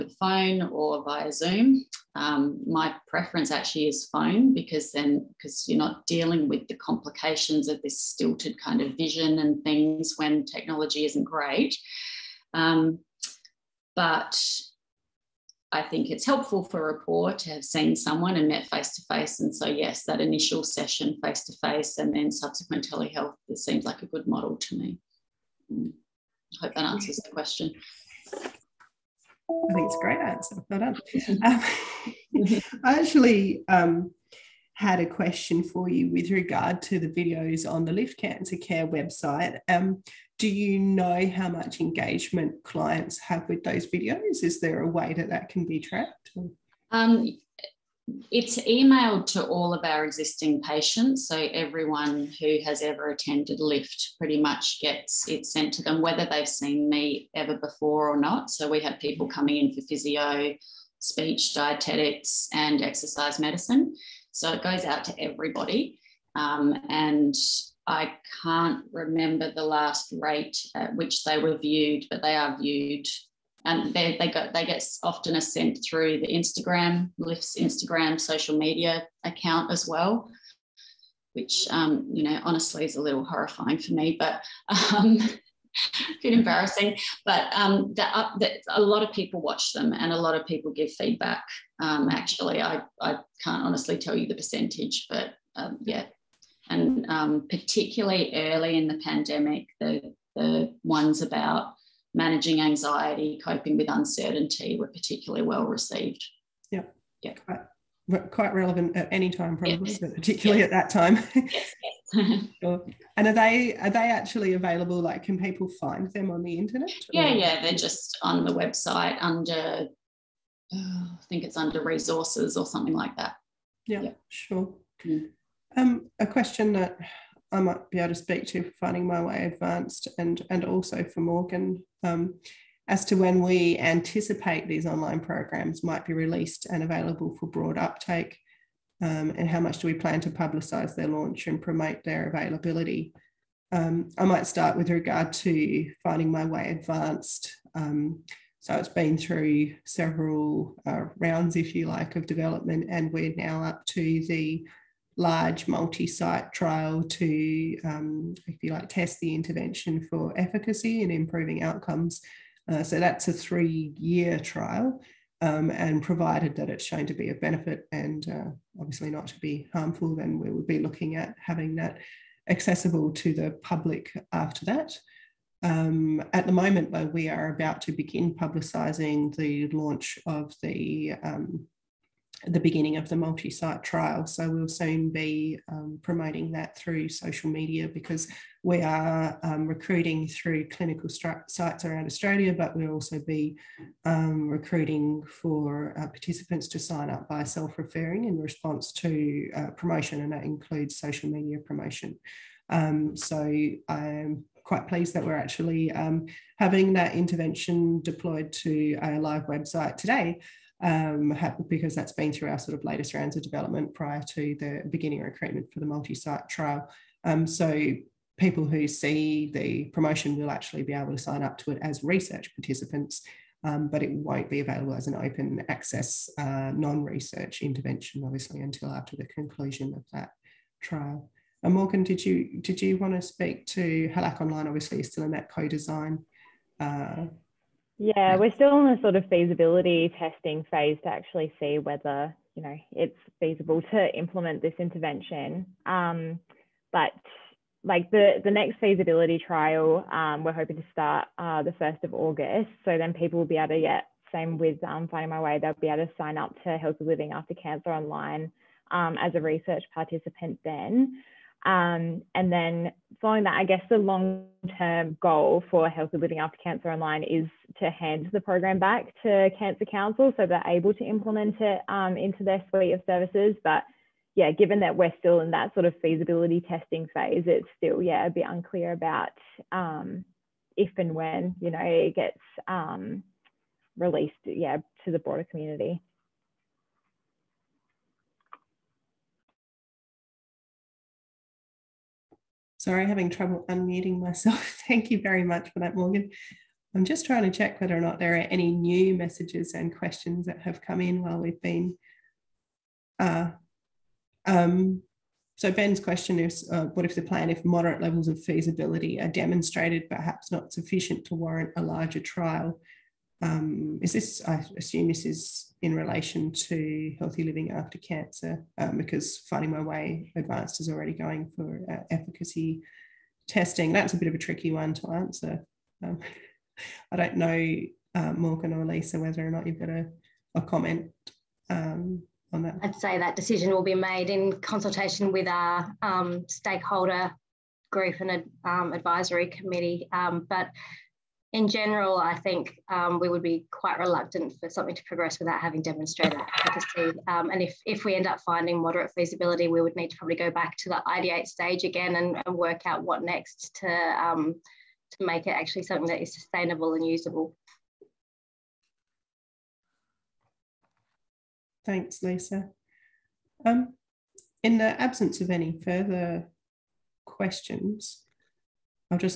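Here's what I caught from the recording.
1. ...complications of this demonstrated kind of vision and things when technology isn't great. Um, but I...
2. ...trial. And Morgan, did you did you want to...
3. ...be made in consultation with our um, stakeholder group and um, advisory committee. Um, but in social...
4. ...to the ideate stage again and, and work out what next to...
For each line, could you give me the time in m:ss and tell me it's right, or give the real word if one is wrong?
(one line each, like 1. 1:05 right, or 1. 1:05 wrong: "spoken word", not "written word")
1. 0:06 wrong: "stilted", not "demonstrated"
2. 3:50 right
3. 5:33 wrong: "general", not "social"
4. 5:50 right.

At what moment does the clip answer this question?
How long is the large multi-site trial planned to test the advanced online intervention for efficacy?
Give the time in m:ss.
2:43.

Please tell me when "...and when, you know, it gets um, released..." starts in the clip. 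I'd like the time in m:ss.
4:40.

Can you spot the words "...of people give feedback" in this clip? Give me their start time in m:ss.
1:30.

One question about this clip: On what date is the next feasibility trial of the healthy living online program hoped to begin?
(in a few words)
1 August.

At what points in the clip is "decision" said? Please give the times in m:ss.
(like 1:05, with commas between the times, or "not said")
5:33.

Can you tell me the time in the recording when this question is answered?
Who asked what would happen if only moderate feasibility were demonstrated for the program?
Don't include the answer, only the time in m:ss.
5:05.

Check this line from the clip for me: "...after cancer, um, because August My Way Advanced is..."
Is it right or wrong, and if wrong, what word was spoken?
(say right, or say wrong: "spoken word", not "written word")
wrong: "Finding", not "August".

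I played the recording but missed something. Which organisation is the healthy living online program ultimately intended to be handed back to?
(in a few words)
Cancer Council.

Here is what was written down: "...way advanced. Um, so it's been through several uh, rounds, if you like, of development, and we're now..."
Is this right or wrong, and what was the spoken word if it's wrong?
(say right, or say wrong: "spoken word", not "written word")
right.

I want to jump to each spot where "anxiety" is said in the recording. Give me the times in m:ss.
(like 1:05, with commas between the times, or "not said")
1:42.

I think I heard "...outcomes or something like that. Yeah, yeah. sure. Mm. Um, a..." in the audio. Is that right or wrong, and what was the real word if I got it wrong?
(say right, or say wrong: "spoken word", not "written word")
wrong: "resources", not "outcomes".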